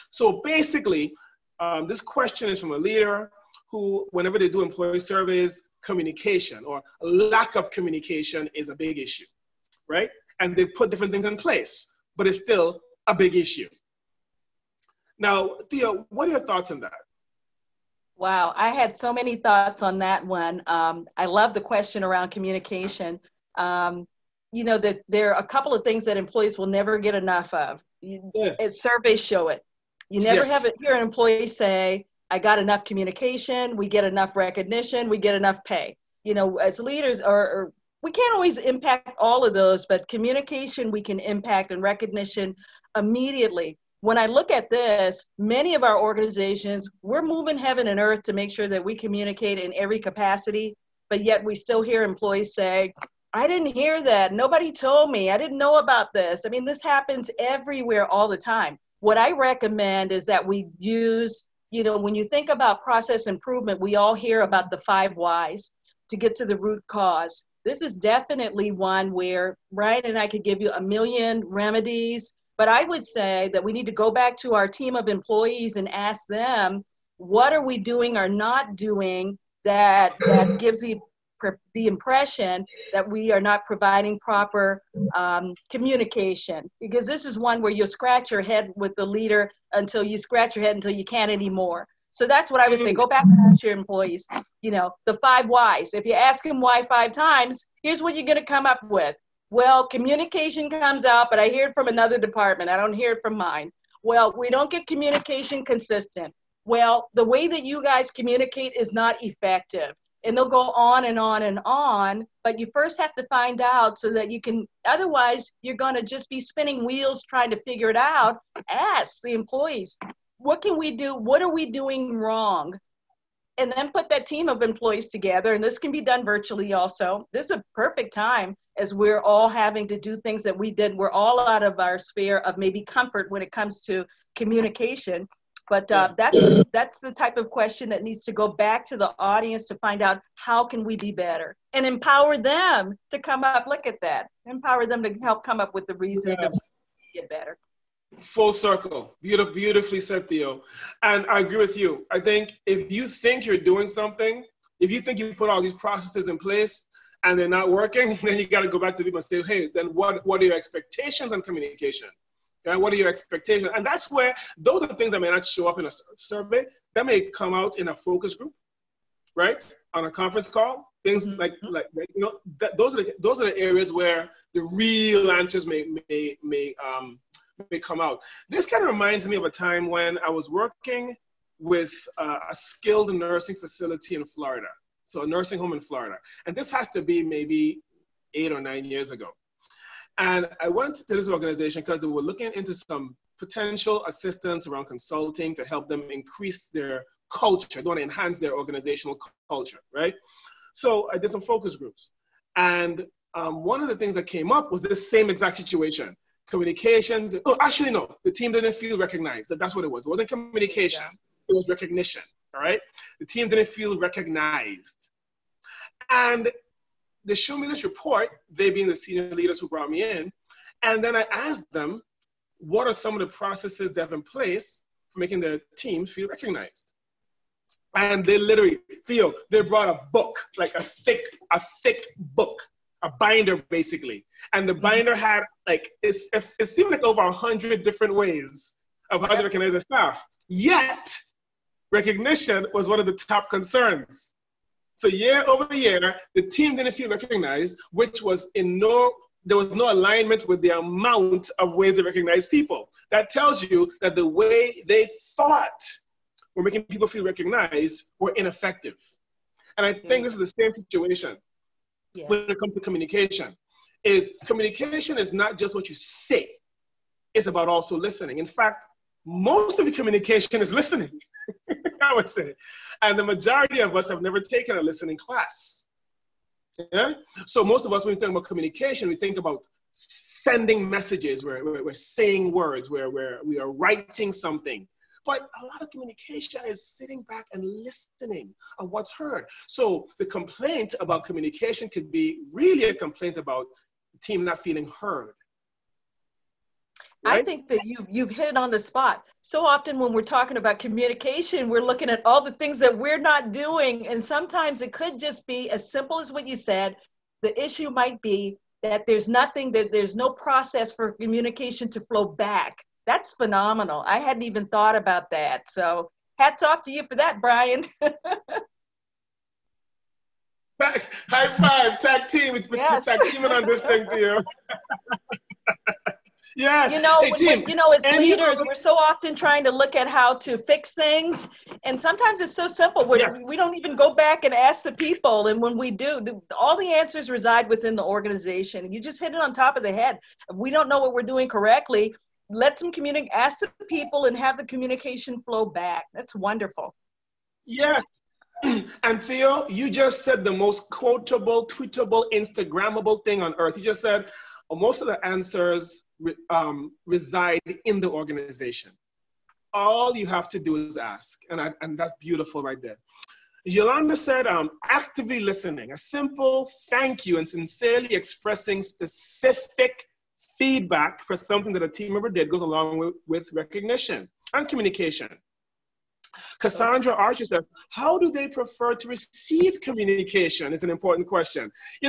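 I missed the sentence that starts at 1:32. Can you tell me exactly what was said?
So that's what I would say.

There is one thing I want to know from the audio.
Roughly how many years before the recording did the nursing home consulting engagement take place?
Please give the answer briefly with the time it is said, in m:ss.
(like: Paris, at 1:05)
8 or 9, at 3:08.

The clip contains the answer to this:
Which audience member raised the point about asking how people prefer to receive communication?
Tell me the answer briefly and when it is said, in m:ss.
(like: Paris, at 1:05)
Cassandra Archer, at 6:16.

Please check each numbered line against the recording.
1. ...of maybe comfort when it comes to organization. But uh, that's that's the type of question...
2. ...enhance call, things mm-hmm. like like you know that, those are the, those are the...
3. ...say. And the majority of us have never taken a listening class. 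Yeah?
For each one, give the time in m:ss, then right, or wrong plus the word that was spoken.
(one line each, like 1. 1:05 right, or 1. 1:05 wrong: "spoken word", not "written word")
1. 2:12 wrong: "communication", not "organization"
2. 2:50 wrong: "conference", not "enhance"
3. 4:32 right.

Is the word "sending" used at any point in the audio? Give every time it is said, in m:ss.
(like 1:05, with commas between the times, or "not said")
4:39.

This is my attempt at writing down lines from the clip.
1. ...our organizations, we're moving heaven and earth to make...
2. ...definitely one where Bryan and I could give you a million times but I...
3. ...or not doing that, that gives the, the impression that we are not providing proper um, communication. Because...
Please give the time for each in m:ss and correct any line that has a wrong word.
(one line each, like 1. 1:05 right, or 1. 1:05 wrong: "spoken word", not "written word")
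1. 0:45 right
2. 1:07 wrong: "remedies", not "times"
3. 1:18 right.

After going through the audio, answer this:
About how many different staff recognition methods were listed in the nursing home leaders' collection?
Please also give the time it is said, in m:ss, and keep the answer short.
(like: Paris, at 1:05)
over 100, at 3:57.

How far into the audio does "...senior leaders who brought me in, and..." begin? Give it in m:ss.
3:38.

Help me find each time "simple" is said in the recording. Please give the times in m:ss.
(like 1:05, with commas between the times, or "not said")
5:05, 5:32, 6:05.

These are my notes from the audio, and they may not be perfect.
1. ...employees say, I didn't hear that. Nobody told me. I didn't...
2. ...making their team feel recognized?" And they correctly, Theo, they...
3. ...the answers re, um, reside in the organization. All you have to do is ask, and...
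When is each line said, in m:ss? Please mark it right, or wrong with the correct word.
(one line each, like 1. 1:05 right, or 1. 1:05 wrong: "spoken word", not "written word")
1. 0:52 right
2. 3:45 wrong: "literally", not "correctly"
3. 5:55 right.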